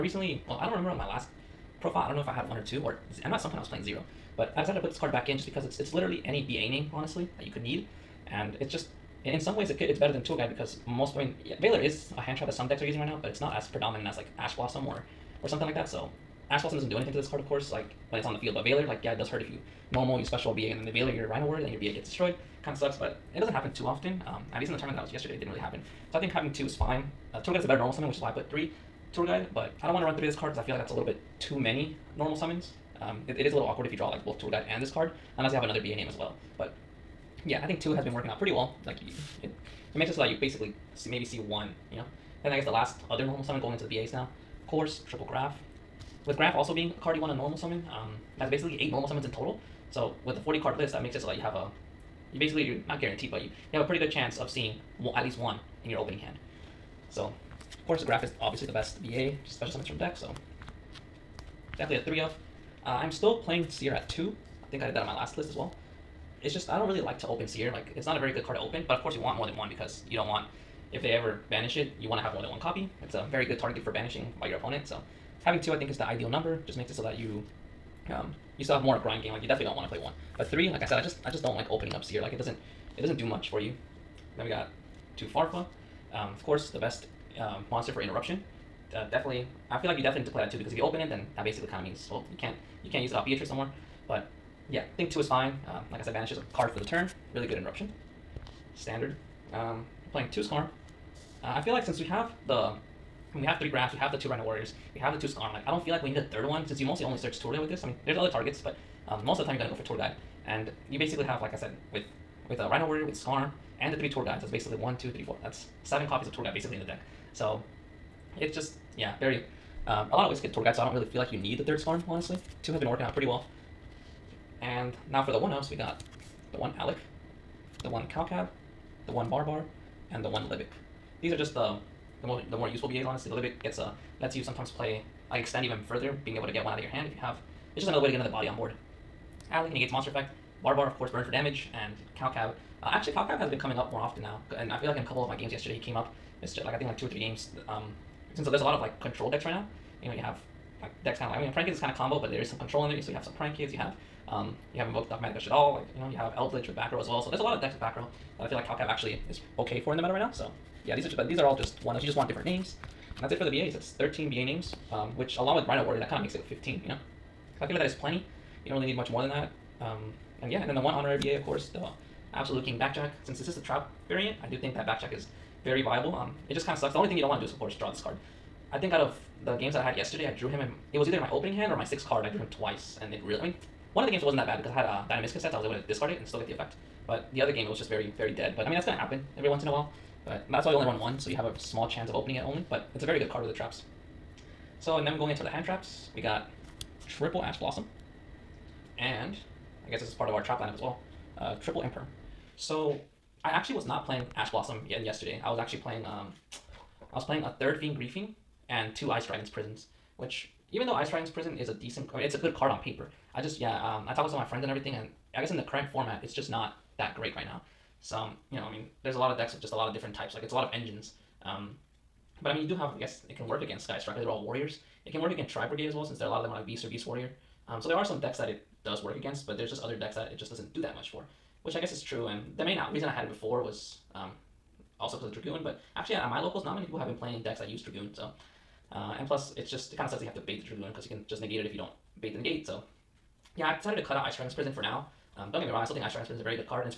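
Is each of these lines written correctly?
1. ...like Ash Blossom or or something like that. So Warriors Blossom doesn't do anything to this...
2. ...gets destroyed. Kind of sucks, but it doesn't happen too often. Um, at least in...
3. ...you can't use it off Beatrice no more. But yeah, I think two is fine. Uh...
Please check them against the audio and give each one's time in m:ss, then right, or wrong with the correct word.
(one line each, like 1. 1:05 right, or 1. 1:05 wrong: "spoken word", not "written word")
1. 0:14 wrong: "Ash", not "Warriors"
2. 0:21 right
3. 1:32 right.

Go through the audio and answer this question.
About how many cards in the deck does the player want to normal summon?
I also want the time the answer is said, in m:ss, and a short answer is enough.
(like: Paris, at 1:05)
8, at 0:48.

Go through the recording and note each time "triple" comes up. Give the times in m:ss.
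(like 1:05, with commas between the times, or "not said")
0:45, 3:17, 3:21.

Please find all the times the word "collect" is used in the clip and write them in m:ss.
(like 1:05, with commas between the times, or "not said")
not said.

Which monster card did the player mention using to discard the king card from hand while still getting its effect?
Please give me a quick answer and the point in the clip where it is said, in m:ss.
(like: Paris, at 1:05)
Dinomischus, at 3:05.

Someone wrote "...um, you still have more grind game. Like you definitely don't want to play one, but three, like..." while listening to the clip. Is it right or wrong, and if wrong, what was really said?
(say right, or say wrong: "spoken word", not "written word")
right.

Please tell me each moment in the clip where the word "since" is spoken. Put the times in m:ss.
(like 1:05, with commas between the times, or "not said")
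1:41, 1:46, 2:28, 2:53, 3:46.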